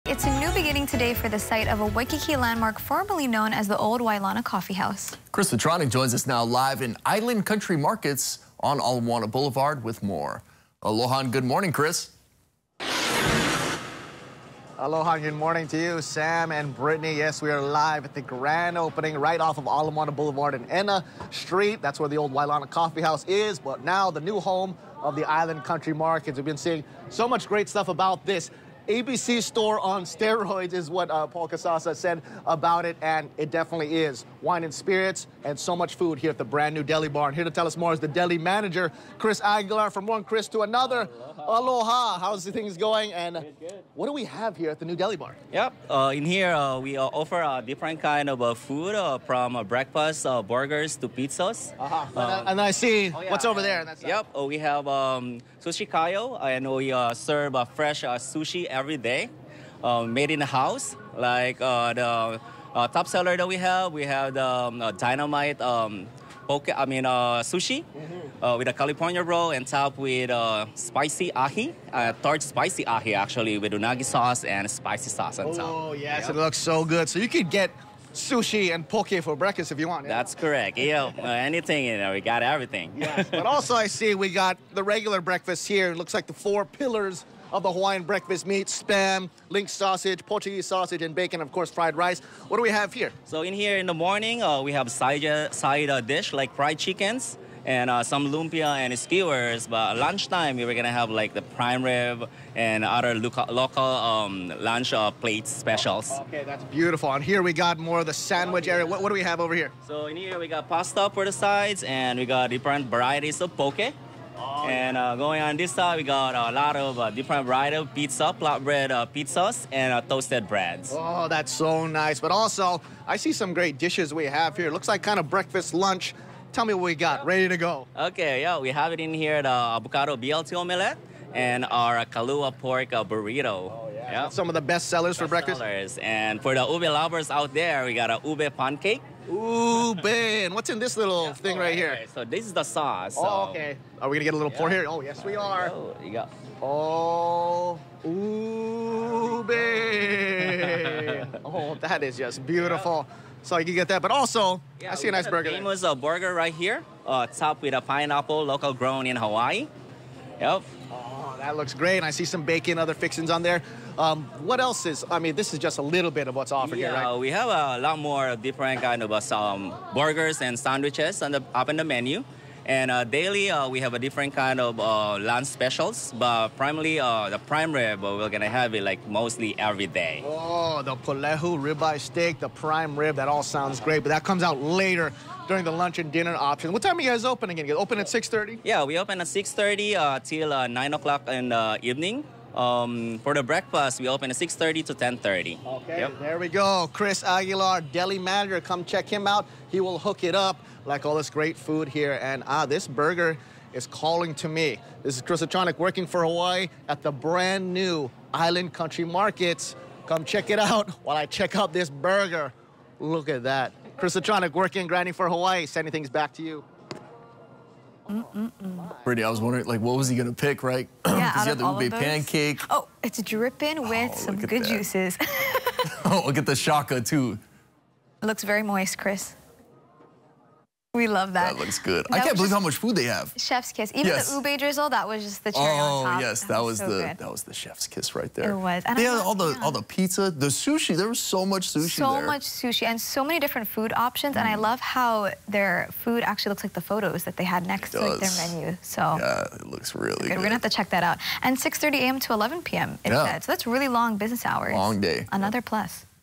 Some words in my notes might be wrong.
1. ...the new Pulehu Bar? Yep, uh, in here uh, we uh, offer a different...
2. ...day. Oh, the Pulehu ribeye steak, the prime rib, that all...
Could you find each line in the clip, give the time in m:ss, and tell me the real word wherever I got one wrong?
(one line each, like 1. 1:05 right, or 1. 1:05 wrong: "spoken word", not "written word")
1. 0:44 wrong: "Deli", not "Pulehu"
2. 2:59 right.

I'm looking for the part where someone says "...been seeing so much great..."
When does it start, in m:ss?
0:26.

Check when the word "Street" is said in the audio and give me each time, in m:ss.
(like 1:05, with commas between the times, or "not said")
0:21.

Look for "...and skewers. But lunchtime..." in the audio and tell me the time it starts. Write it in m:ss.
1:38.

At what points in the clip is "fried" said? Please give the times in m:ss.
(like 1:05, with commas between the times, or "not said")
1:31, 1:36.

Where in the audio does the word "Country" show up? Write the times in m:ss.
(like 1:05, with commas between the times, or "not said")
0:07, 0:25, 3:28.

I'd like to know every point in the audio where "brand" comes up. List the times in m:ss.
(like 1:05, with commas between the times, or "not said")
0:36, 3:27.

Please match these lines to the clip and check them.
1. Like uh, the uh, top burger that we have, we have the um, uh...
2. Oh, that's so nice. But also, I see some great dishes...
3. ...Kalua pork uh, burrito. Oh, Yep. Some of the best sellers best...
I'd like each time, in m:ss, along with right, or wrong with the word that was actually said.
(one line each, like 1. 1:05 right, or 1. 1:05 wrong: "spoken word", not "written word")
1. 1:01 wrong: "seller", not "burger"
2. 2:00 right
3. 2:12 right.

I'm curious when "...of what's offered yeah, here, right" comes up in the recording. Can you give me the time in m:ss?
2:46.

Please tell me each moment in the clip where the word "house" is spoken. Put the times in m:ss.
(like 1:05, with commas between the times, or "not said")
0:04, 0:23, 1:00.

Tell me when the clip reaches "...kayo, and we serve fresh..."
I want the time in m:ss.
0:55.